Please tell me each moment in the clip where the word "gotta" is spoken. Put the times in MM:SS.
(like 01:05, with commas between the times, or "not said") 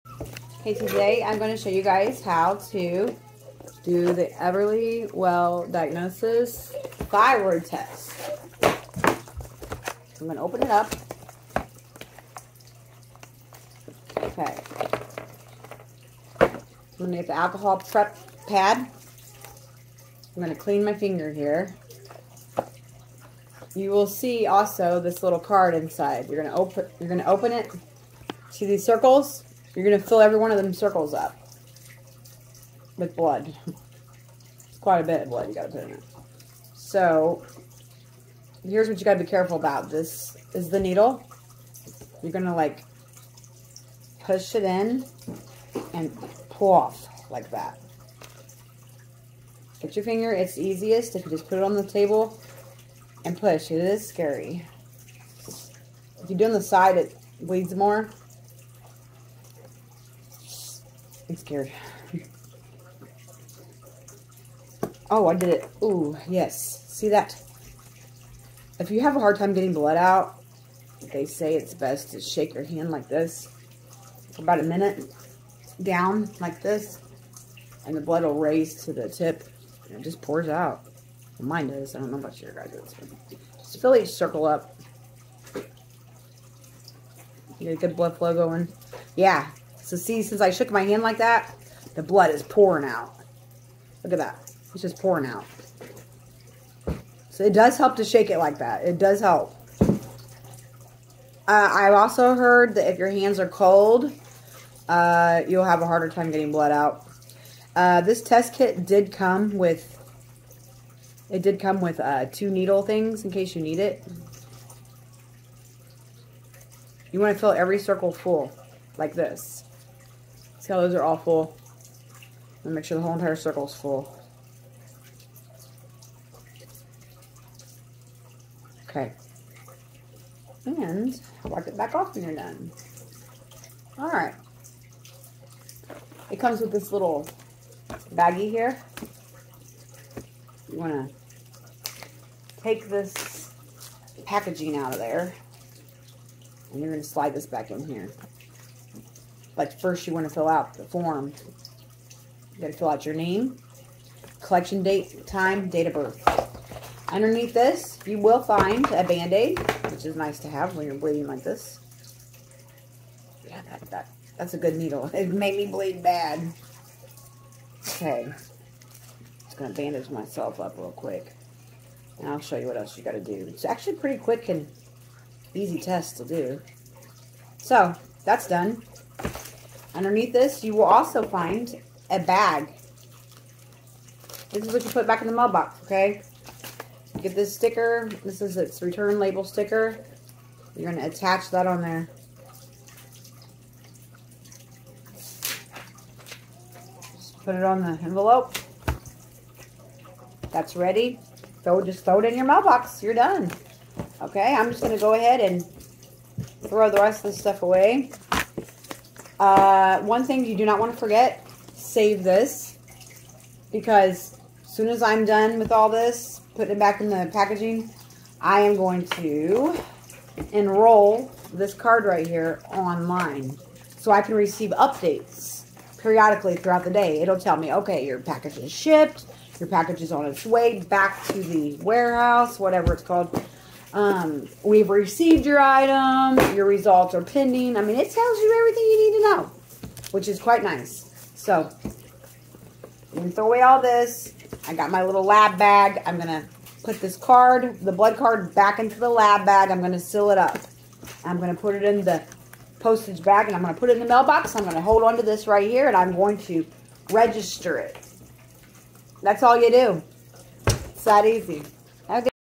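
02:32, 02:53.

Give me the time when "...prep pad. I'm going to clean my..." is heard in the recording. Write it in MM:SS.
00:17.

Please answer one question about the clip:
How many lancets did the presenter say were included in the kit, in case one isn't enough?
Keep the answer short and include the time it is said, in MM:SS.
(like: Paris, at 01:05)
2, at 01:52.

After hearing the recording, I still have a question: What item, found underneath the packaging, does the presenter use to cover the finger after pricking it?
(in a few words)
band-aid.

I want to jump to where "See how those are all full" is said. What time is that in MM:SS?
02:00.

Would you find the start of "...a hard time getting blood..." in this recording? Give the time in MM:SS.
01:09.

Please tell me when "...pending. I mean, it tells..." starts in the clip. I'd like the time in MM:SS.
03:57.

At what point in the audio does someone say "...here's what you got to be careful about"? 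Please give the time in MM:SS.
00:38.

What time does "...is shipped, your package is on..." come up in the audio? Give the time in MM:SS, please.
03:48.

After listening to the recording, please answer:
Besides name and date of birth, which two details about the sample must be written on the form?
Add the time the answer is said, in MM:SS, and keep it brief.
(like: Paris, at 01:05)
collection date, time, at 02:34.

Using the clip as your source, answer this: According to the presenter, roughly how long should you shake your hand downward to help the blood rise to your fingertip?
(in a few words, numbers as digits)
about a minute.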